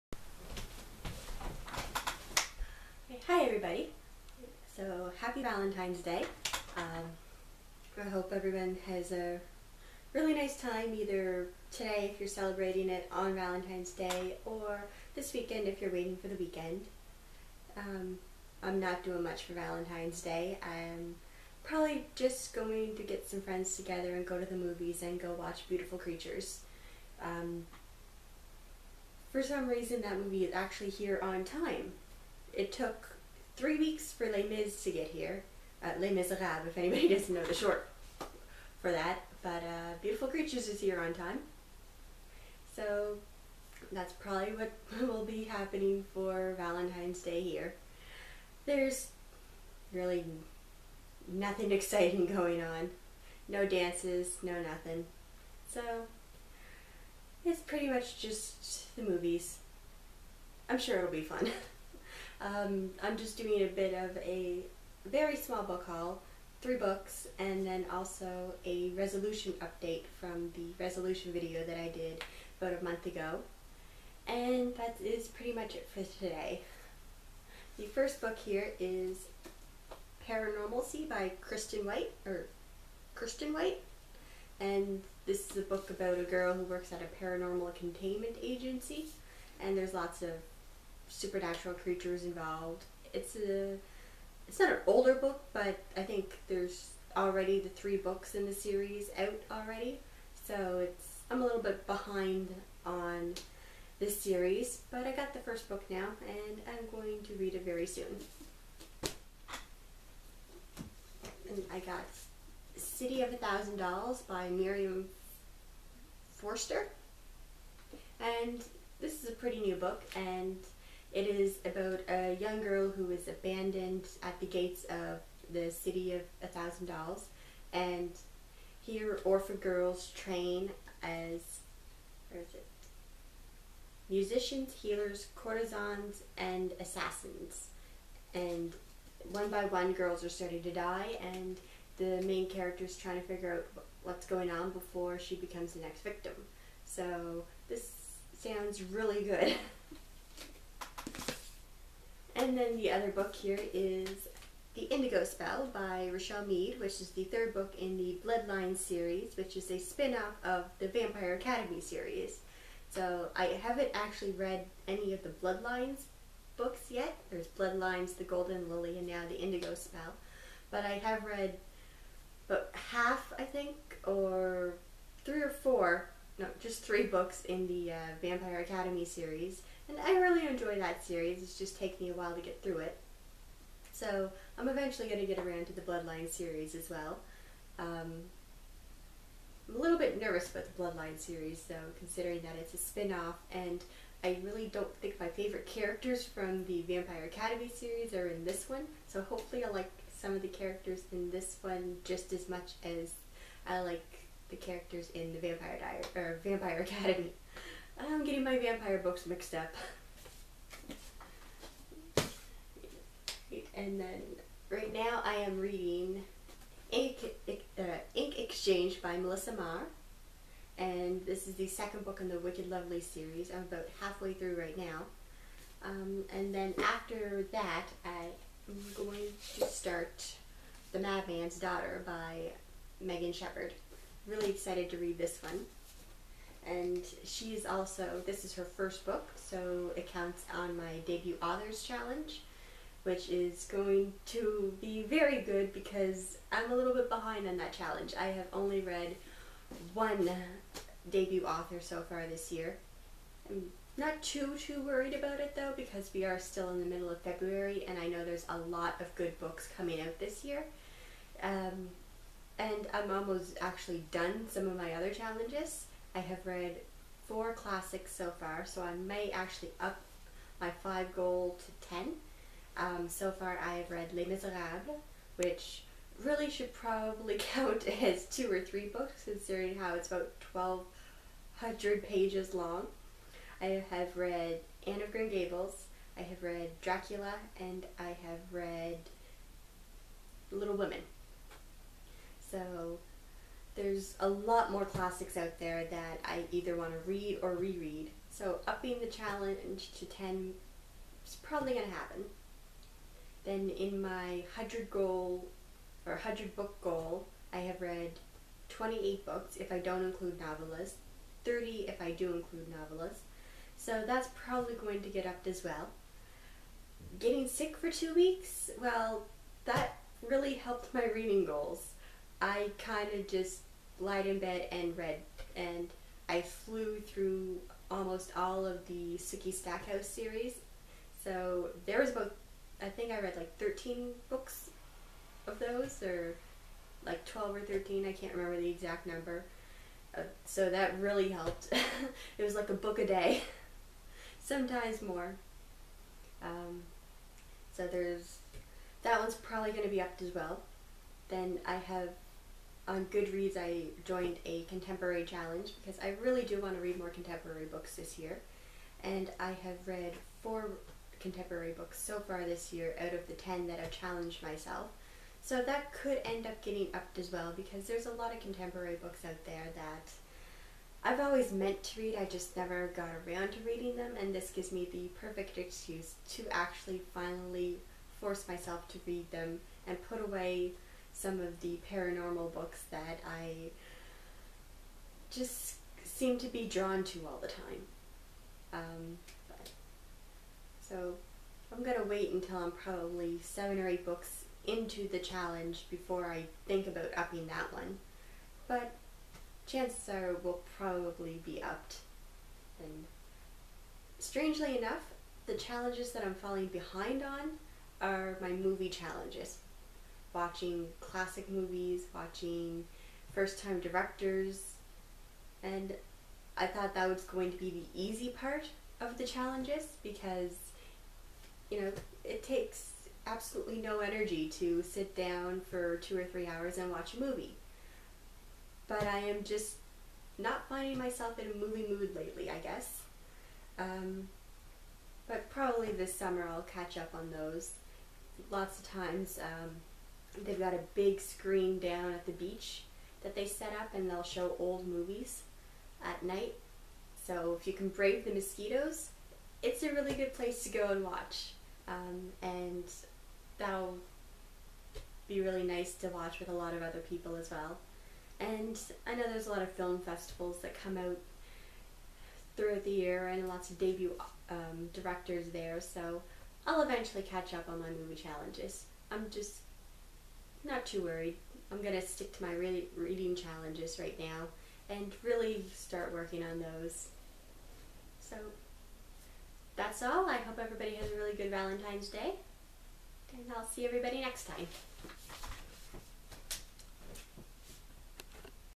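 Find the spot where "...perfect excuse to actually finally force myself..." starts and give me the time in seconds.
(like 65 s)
375 s.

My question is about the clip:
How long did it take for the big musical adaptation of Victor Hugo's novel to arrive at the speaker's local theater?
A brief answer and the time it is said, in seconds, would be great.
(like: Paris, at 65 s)
3 weeks, at 33 s.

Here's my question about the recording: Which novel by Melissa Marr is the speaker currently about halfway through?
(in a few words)
Ink Exchange.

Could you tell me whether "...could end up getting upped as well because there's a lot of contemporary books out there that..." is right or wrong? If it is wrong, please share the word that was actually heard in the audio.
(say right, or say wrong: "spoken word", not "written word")
right.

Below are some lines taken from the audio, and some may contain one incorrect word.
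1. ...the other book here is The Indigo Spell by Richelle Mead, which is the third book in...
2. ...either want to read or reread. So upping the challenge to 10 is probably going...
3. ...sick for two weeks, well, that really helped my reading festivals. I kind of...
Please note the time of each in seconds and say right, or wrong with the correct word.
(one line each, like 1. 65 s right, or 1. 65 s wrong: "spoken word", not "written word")
1. 152 s right
2. 296 s right
3. 317 s wrong: "goals", not "festivals".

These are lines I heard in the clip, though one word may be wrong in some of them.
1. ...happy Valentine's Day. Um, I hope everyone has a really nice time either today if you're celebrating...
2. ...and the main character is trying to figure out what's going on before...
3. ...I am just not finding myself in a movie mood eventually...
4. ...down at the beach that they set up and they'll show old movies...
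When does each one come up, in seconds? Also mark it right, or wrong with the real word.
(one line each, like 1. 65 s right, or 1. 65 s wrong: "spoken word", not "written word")
1. 5 s right
2. 141 s right
3. 429 s wrong: "lately", not "eventually"
4. 441 s right.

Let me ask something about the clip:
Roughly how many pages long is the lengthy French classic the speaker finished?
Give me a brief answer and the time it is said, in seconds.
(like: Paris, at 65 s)
1,200, at 280 s.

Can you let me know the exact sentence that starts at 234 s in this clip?
Really excited to read this one.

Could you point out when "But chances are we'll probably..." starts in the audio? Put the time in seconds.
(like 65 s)
398 s.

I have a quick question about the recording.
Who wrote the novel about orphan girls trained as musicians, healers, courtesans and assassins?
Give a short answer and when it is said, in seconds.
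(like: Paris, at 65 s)
Miriam Forster, at 114 s.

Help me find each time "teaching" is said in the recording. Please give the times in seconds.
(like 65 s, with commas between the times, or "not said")
not said.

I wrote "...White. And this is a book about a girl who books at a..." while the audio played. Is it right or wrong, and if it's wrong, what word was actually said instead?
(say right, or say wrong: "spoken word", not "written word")
wrong: "works", not "books".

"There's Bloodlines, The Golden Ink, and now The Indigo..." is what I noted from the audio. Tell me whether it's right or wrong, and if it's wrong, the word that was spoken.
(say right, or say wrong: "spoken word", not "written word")
wrong: "Lily", not "Ink".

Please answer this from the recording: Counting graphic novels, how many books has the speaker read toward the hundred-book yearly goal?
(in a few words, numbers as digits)
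30.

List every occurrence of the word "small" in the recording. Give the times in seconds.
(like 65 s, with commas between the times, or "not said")
65 s.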